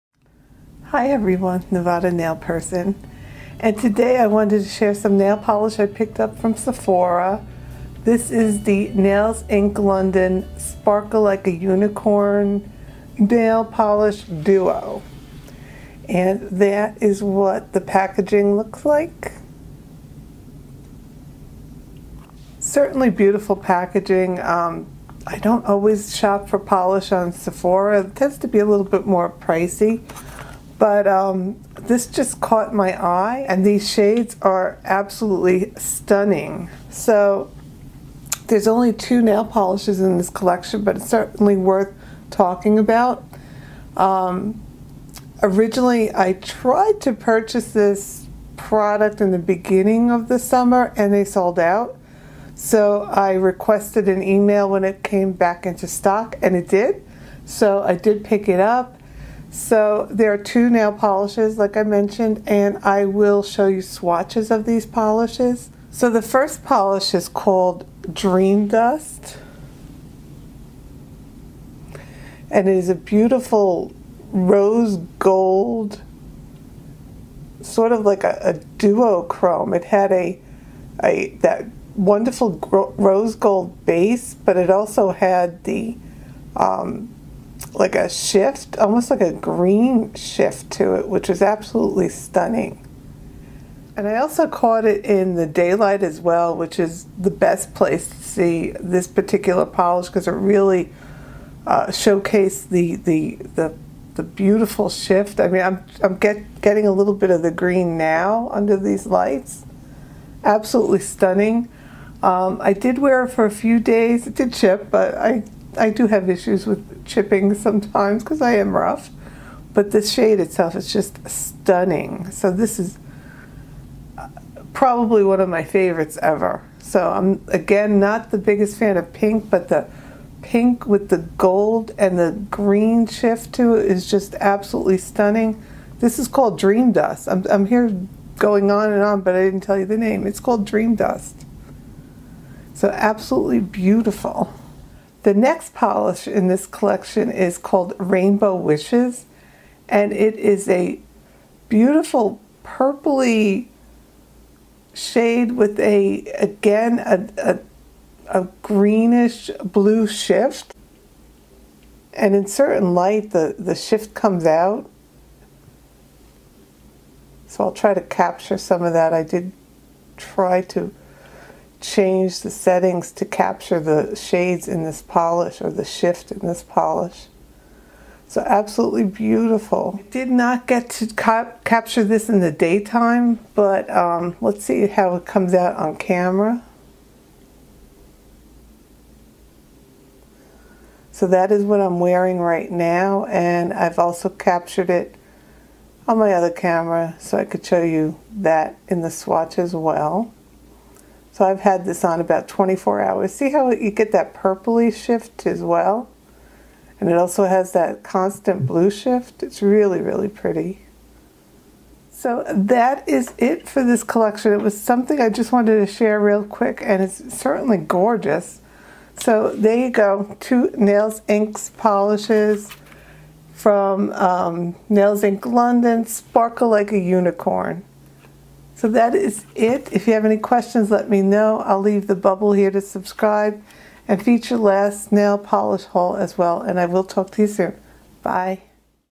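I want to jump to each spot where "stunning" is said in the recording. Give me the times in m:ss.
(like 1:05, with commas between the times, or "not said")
0:35, 1:32, 1:50, 2:01, 2:14.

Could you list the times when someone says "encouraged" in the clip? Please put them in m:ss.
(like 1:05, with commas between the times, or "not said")
not said.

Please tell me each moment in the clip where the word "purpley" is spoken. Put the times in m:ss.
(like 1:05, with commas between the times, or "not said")
2:32, 3:24.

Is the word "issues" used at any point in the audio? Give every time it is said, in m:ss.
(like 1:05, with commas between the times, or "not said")
1:56.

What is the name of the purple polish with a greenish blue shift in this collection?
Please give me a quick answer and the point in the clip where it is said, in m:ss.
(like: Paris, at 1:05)
Rainbow Wishes, at 2:27.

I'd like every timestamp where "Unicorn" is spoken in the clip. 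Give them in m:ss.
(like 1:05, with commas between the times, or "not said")
0:11, 3:46.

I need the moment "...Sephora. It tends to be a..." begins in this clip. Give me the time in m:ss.
0:27.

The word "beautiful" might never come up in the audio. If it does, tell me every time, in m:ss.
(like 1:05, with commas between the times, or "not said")
0:23, 1:12, 1:44, 2:23, 2:31, 2:59.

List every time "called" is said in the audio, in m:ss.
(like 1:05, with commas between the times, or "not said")
1:07, 2:16, 2:20, 2:27.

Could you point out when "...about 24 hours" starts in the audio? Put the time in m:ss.
3:22.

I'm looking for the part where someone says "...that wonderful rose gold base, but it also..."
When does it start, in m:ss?
1:21.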